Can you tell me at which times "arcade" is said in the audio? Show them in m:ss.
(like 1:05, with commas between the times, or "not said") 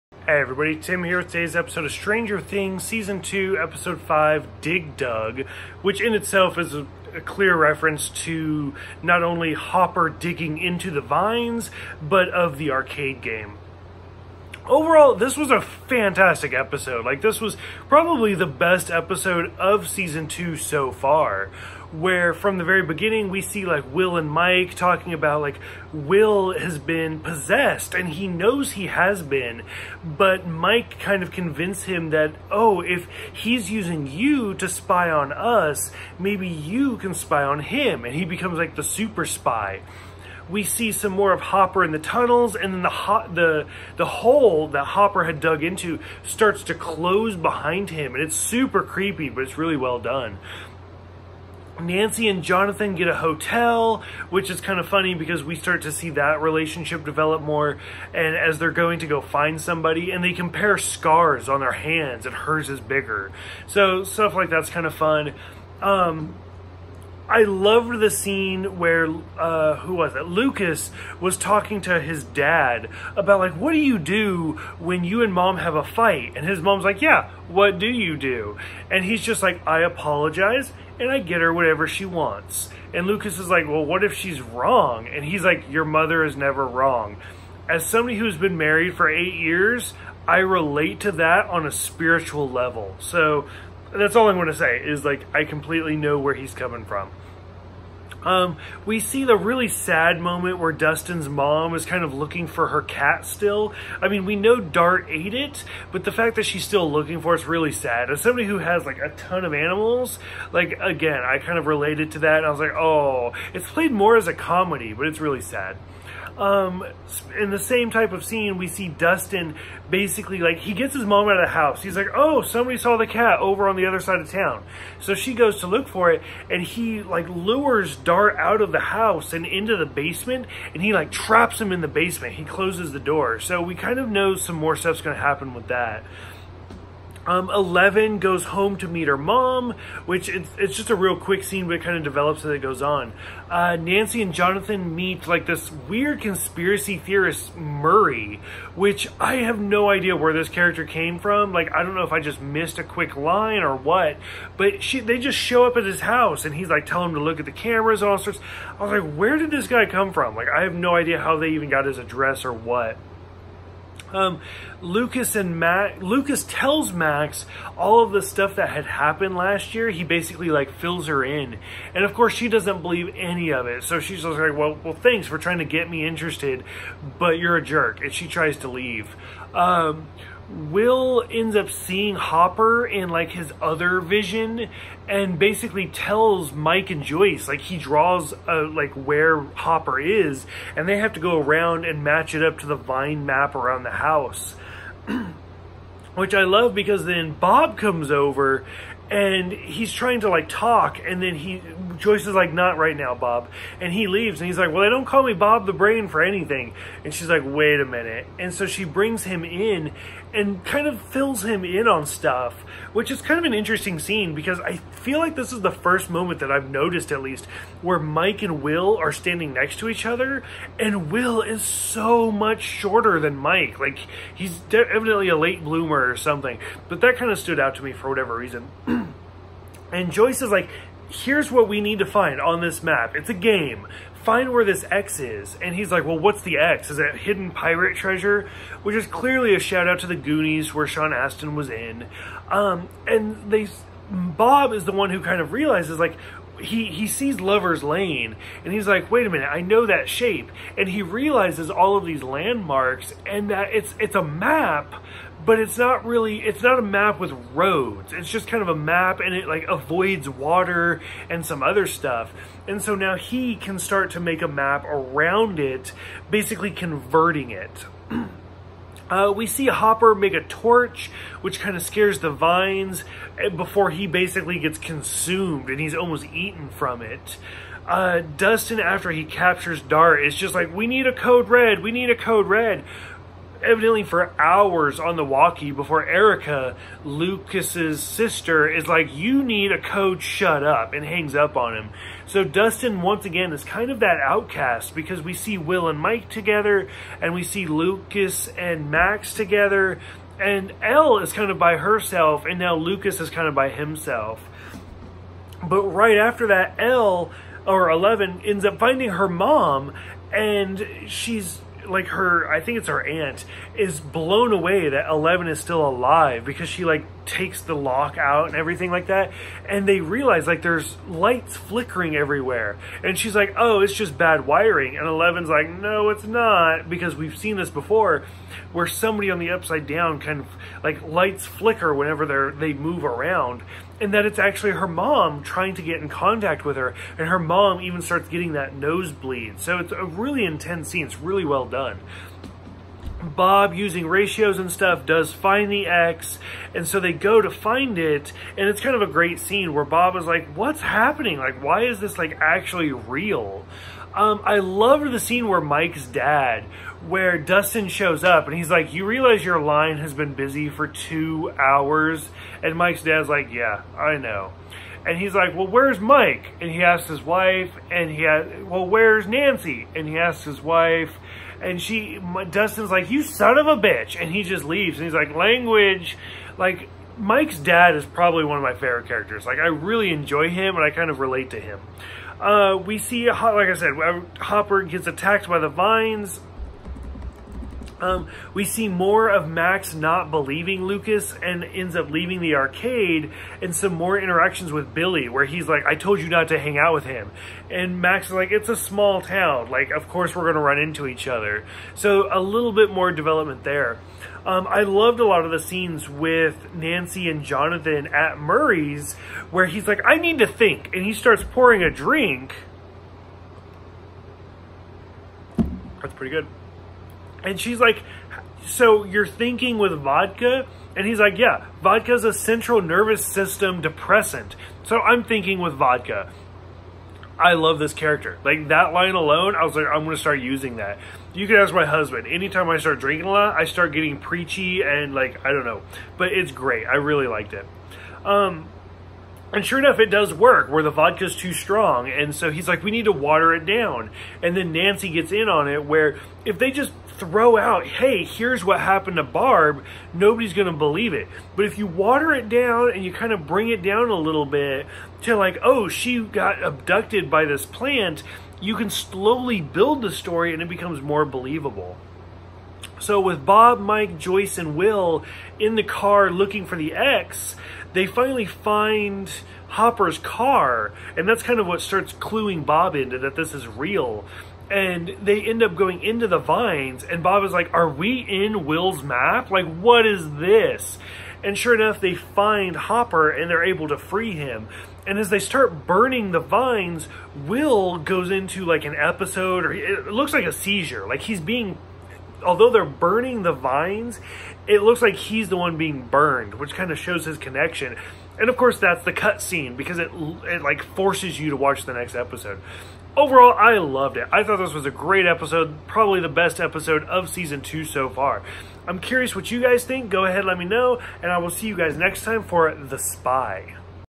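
0:12, 6:32.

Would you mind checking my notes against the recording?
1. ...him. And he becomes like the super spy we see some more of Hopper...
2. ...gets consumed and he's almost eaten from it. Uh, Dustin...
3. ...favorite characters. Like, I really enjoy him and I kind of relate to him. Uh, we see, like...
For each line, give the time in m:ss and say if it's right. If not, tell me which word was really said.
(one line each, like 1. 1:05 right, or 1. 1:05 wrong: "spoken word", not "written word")
1. 0:37 right
2. 4:34 right
3. 6:18 right.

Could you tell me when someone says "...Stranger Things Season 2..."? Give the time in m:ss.
0:01.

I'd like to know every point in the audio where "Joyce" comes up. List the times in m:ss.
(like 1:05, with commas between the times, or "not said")
3:07, 3:22, 3:50, 7:44.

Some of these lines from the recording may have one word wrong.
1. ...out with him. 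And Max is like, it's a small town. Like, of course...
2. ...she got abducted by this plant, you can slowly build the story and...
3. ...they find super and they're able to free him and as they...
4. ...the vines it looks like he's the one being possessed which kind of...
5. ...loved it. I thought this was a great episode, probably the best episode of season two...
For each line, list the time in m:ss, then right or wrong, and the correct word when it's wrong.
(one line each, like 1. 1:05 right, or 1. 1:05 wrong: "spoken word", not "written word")
1. 6:36 right
2. 7:35 right
3. 8:01 wrong: "hopper", not "super"
4. 8:13 wrong: "burned", not "possessed"
5. 8:23 right.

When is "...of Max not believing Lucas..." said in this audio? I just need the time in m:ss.
6:29.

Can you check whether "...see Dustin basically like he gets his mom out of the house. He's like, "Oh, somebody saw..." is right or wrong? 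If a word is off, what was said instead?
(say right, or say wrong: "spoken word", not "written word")
right.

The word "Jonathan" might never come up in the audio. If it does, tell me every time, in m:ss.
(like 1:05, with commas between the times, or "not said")
0:52, 2:24, 6:47.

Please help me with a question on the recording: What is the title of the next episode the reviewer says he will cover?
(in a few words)
The Spy.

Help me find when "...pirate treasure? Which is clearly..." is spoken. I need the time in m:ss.
3:57.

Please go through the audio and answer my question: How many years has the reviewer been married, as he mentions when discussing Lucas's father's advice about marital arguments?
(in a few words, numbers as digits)
8.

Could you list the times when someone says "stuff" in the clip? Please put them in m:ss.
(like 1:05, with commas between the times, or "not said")
1:04, 2:14, 2:48, 3:32, 4:21, 5:44.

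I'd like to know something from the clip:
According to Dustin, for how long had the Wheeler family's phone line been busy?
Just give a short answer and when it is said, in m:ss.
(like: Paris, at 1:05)
2 hours, at 6:00.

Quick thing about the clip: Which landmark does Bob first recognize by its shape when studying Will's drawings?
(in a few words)
Lover's Lane.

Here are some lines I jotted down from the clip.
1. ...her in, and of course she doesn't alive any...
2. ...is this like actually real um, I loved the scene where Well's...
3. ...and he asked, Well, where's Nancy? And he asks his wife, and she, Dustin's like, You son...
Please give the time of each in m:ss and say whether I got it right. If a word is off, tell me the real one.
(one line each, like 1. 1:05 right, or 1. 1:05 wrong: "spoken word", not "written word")
1. 2:51 wrong: "believe", not "alive"
2. 5:51 wrong: "Mike", not "Well"
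3. 6:07 right.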